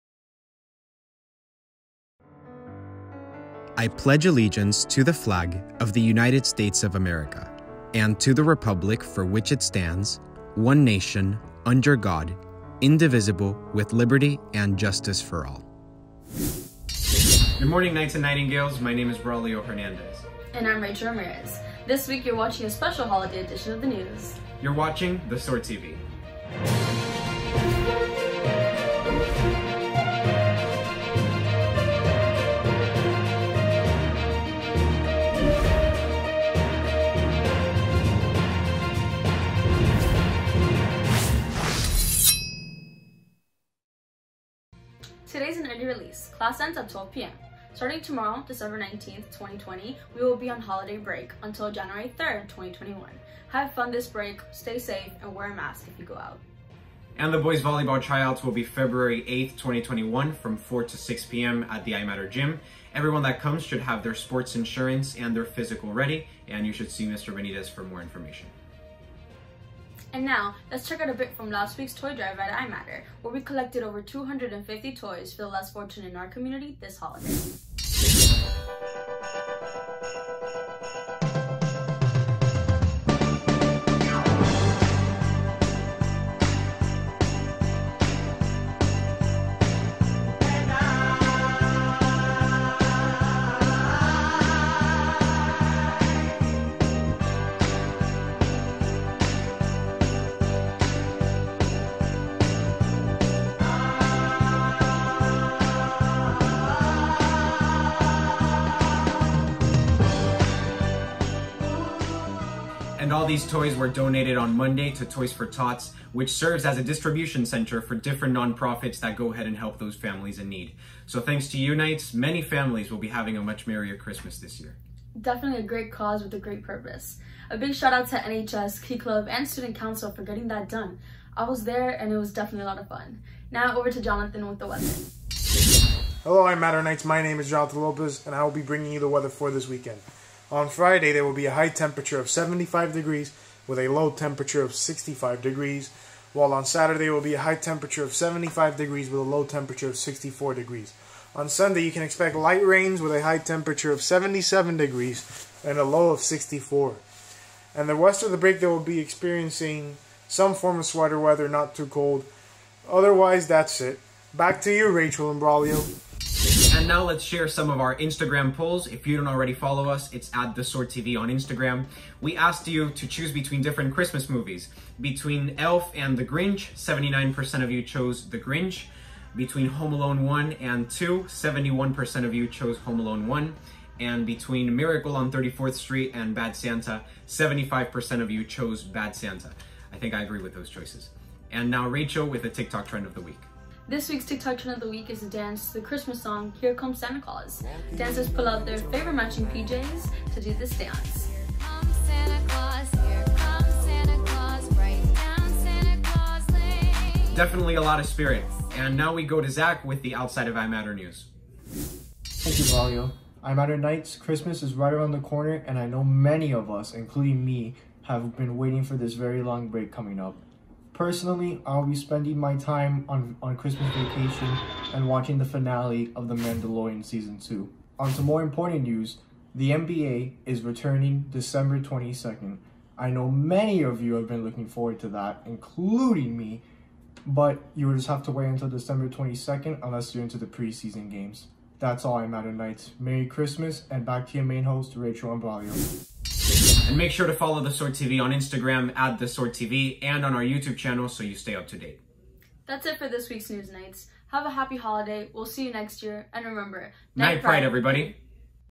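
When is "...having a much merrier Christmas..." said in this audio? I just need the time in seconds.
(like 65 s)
123 s.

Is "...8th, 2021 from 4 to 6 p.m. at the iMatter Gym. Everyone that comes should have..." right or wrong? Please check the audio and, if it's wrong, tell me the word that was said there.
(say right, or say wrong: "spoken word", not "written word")
right.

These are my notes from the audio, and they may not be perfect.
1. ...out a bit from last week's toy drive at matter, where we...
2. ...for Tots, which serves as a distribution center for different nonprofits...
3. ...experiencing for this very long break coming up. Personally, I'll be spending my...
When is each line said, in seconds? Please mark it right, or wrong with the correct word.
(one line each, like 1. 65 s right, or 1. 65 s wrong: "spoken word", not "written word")
1. 70 s wrong: "iMatter", not "matter"
2. 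115 s right
3. 218 s wrong: "waiting", not "experiencing".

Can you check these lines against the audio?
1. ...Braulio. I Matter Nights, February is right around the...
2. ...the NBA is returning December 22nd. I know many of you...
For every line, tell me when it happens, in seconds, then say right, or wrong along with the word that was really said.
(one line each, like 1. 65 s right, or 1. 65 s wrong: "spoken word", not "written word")
1. 212 s wrong: "Christmas", not "February"
2. 229 s right.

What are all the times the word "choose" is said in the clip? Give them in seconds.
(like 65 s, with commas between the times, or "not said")
173 s.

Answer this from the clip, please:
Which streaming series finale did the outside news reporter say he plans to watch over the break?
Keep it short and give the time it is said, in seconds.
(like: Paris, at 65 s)
The Mandalorian, at 226 s.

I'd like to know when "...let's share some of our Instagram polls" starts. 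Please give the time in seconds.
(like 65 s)
167 s.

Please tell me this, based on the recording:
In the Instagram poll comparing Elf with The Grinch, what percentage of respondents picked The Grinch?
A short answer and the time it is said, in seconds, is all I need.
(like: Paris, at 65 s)
79%, at 176 s.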